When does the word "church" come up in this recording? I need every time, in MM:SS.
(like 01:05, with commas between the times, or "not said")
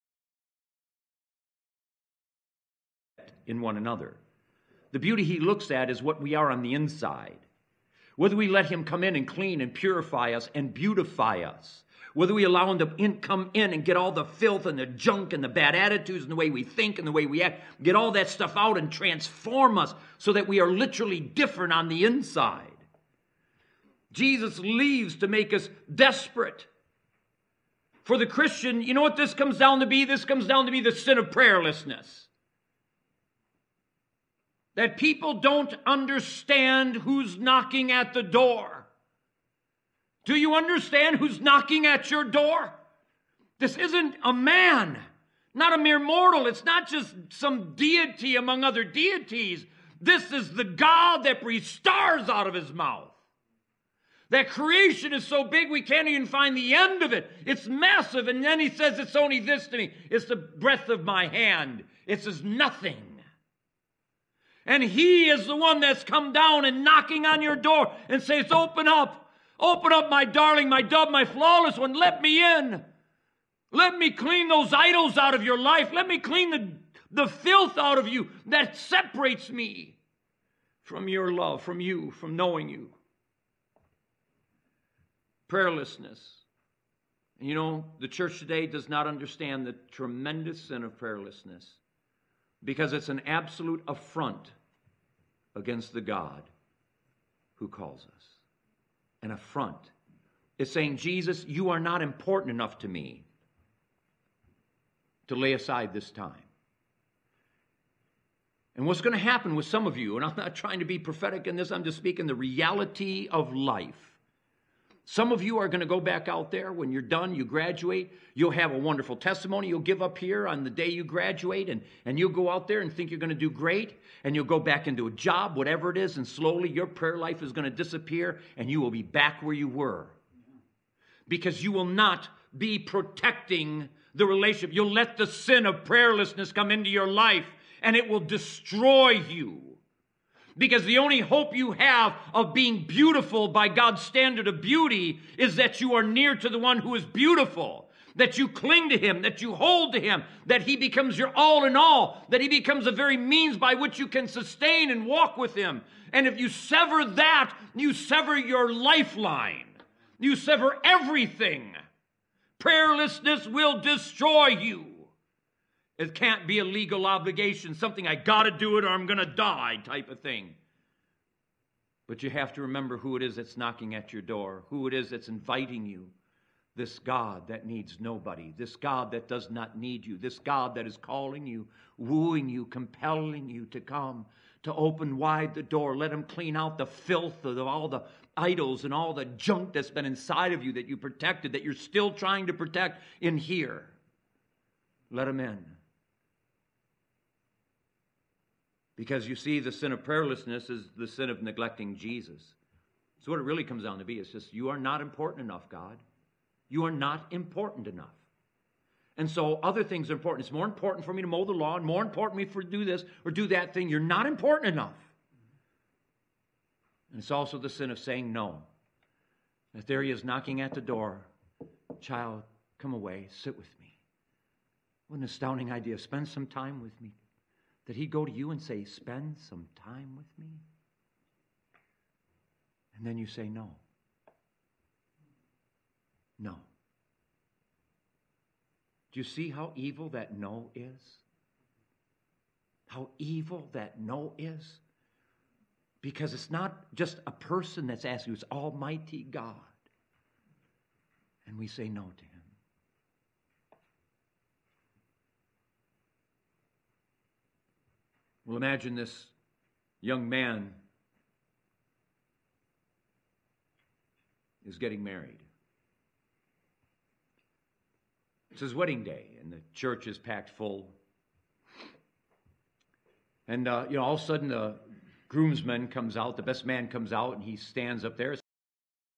01:28, 04:29.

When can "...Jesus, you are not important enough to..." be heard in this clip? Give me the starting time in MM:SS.
01:40.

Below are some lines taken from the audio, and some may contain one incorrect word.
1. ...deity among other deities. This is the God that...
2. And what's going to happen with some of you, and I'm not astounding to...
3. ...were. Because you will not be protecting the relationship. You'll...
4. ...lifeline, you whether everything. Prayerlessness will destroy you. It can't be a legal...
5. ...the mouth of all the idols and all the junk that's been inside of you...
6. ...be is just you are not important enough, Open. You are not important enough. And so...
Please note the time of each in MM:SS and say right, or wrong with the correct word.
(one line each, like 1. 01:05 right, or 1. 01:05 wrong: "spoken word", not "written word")
1. 00:47 right
2. 01:48 wrong: "trying", not "astounding"
3. 02:09 right
4. 02:38 wrong: "sever", not "whether"
5. 03:06 wrong: "filth", not "mouth"
6. 03:24 wrong: "God", not "Open".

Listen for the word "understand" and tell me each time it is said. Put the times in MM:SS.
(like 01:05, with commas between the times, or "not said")
00:35, 00:40, 01:29.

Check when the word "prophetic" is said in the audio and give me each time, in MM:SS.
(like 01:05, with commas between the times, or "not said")
01:50.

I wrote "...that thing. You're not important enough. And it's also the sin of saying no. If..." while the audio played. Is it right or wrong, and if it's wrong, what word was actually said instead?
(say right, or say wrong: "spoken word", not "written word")
right.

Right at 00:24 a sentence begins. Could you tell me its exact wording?
Jesus leaves to make us desperate.